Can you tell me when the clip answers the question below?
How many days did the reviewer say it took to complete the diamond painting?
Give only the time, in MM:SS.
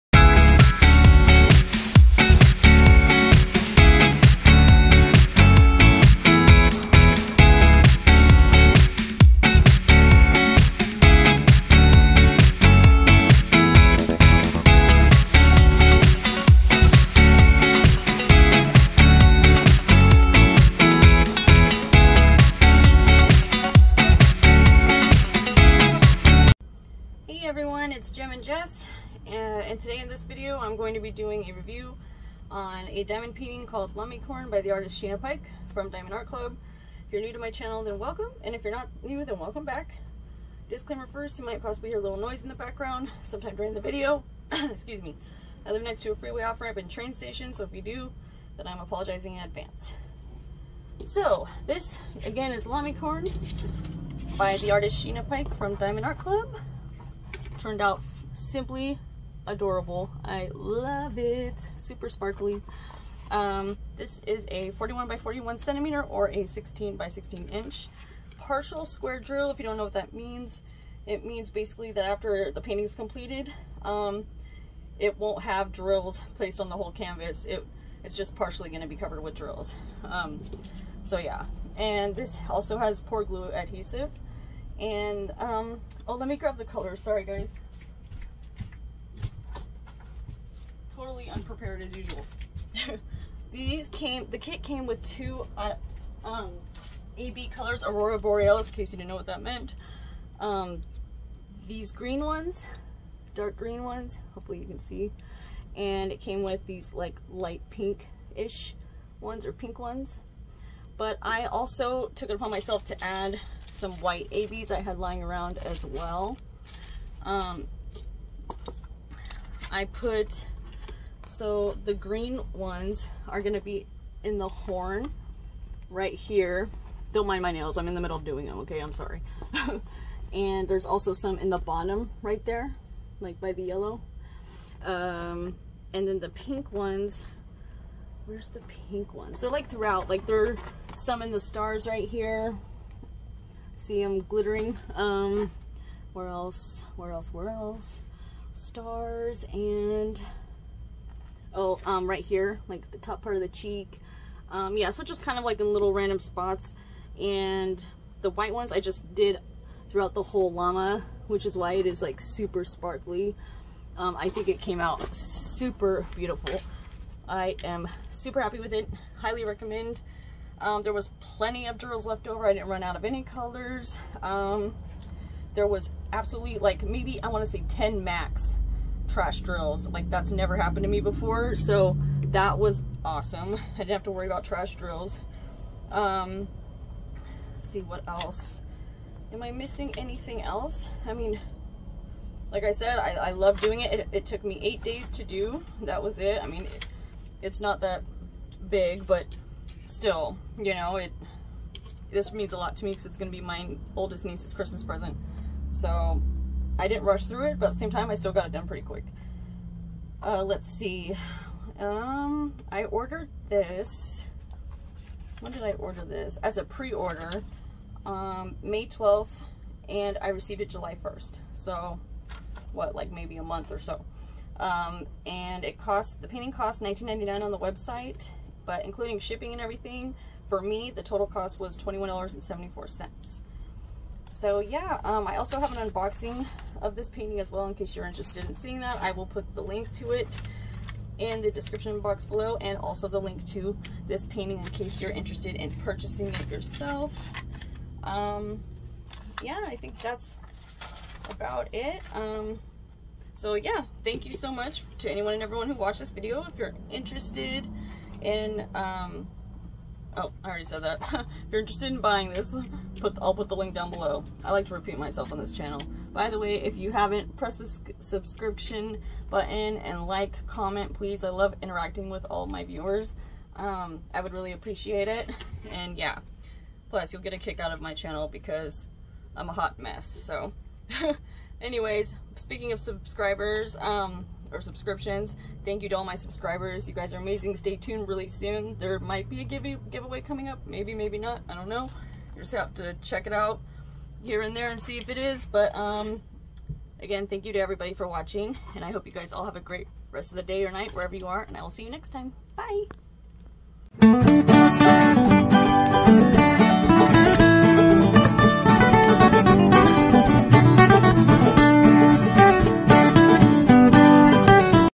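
03:14.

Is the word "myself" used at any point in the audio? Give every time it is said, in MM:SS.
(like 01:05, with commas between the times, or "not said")
01:52, 04:24.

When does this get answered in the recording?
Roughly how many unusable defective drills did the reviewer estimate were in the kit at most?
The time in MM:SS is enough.
02:57.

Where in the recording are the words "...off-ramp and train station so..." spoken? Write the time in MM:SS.
00:46.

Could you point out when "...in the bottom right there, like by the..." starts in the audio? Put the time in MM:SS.
02:11.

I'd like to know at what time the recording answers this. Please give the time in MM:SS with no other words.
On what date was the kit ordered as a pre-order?
03:38.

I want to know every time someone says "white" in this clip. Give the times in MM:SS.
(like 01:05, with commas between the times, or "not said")
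01:53, 02:38.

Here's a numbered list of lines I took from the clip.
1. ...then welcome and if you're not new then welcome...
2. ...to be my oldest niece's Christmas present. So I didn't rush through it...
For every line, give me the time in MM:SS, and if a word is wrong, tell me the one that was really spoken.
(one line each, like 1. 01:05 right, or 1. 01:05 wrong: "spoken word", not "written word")
1. 00:37 right
2. 03:23 right.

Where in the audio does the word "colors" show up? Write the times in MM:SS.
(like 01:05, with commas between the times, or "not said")
01:26, 01:37, 02:53.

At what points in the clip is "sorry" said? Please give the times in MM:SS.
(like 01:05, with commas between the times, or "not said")
01:26, 02:08.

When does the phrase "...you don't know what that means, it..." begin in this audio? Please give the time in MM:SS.
01:09.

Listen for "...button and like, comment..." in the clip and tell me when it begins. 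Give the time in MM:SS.
04:29.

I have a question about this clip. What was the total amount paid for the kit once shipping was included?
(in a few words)
$21.74.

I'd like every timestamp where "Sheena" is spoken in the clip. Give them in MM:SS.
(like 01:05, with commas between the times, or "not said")
00:35, 00:55.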